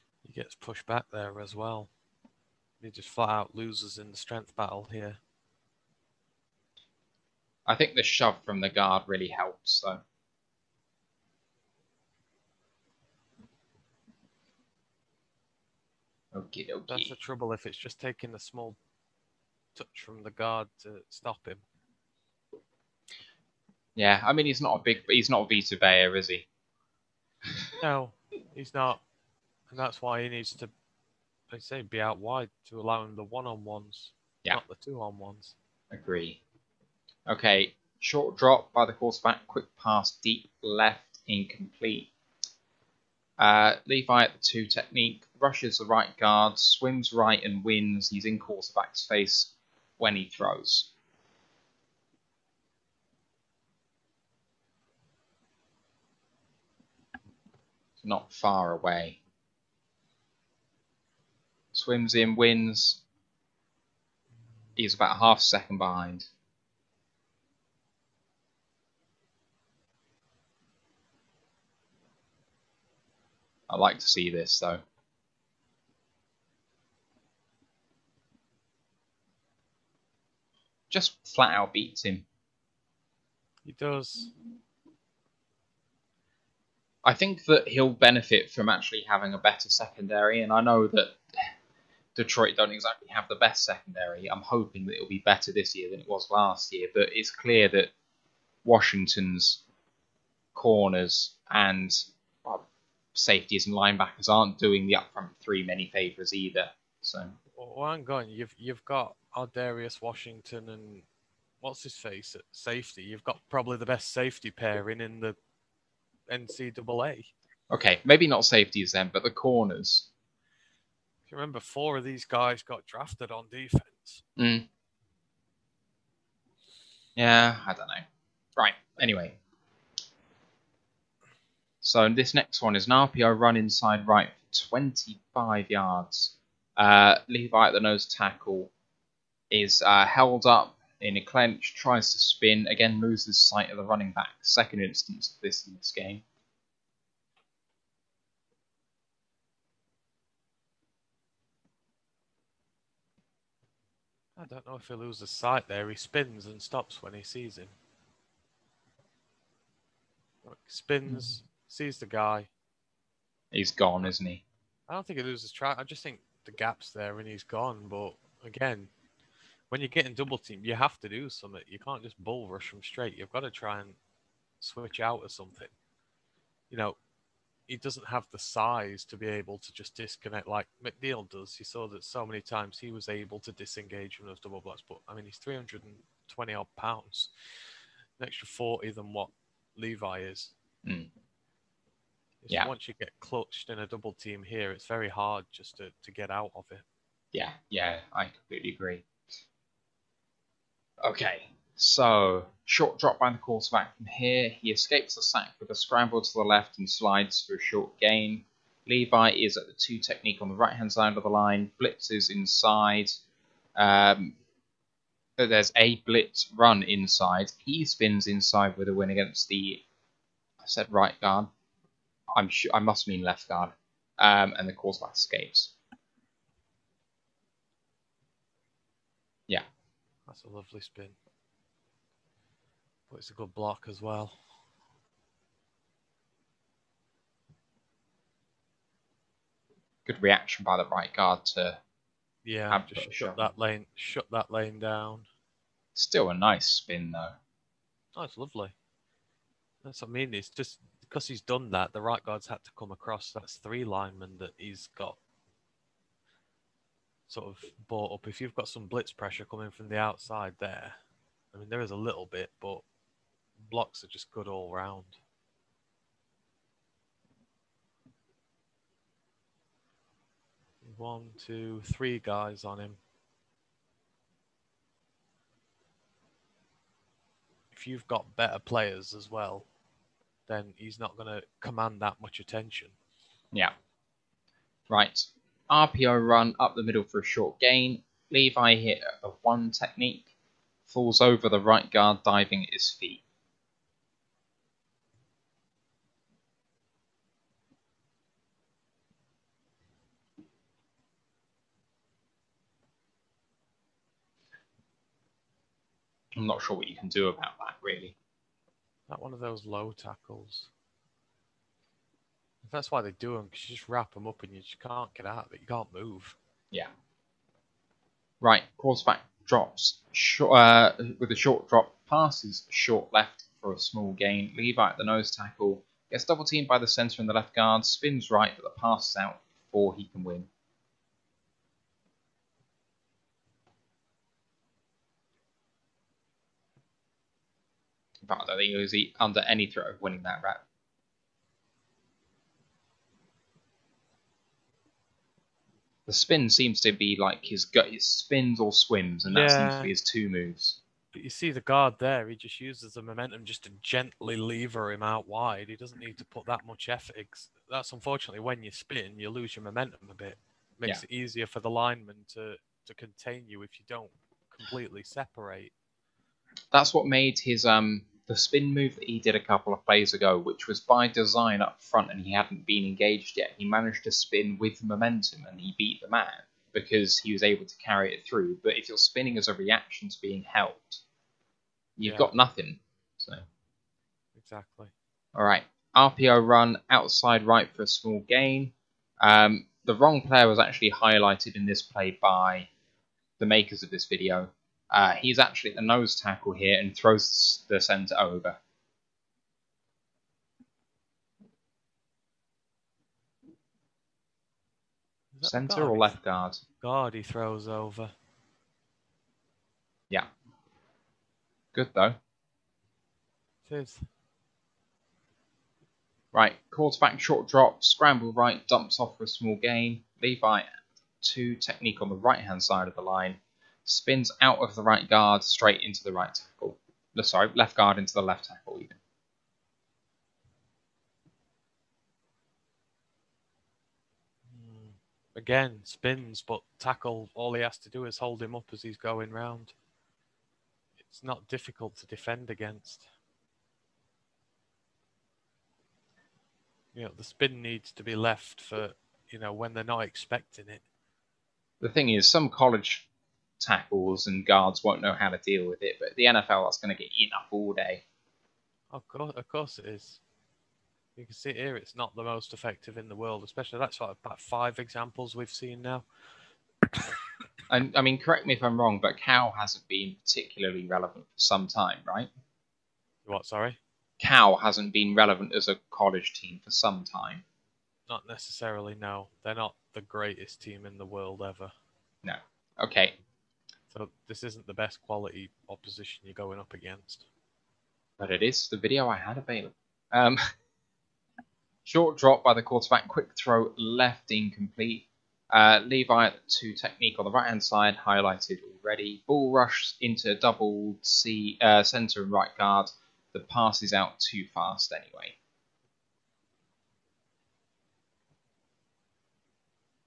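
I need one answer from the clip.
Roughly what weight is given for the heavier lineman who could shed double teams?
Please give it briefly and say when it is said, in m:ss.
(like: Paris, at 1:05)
320 pounds, at 3:05.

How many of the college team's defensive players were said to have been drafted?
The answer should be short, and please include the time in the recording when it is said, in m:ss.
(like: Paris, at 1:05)
4, at 2:01.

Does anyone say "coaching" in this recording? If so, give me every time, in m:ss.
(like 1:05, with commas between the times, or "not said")
not said.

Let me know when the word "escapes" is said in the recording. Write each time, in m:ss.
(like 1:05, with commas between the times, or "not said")
3:24, 3:45.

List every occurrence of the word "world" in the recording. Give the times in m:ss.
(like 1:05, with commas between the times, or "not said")
7:43, 8:01.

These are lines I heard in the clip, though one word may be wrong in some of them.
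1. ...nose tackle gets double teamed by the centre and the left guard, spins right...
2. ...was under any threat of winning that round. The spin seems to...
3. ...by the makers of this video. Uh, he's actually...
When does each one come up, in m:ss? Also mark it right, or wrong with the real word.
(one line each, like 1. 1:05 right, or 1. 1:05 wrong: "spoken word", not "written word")
1. 5:25 right
2. 5:38 right
3. 6:32 right.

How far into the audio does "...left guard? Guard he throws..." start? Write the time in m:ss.
6:45.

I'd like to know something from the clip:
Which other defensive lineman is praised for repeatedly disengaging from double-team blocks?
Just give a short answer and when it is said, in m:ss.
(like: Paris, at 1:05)
McNeill, at 3:00.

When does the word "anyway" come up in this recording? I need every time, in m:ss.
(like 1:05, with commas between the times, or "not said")
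2:08, 8:24.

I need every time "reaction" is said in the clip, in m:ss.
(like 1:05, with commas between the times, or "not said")
4:00, 6:19.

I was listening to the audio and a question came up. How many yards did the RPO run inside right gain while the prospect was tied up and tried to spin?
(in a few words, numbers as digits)
25.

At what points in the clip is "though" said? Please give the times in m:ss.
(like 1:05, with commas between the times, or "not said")
0:09, 1:14, 4:07, 6:51.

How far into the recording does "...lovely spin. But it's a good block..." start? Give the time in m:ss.
3:50.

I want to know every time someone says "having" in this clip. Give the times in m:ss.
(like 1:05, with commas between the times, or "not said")
1:29.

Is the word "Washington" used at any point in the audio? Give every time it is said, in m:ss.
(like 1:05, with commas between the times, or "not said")
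1:38, 1:49.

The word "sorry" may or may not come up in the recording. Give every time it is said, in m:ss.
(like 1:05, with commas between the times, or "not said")
7:07, 7:53.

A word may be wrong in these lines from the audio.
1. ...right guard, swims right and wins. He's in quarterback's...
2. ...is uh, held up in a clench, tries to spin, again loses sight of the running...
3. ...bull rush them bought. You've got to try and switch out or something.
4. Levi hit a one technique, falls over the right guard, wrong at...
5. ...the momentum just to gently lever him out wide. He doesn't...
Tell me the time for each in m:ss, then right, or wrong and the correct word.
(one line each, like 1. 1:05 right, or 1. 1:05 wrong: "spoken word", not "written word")
1. 0:45 right
2. 2:19 right
3. 2:52 wrong: "straight", not "bought"
4. 4:48 wrong: "diving", not "wrong"
5. 5:52 right.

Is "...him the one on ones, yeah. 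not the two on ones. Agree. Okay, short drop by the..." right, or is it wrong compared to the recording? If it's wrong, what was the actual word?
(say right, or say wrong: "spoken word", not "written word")
right.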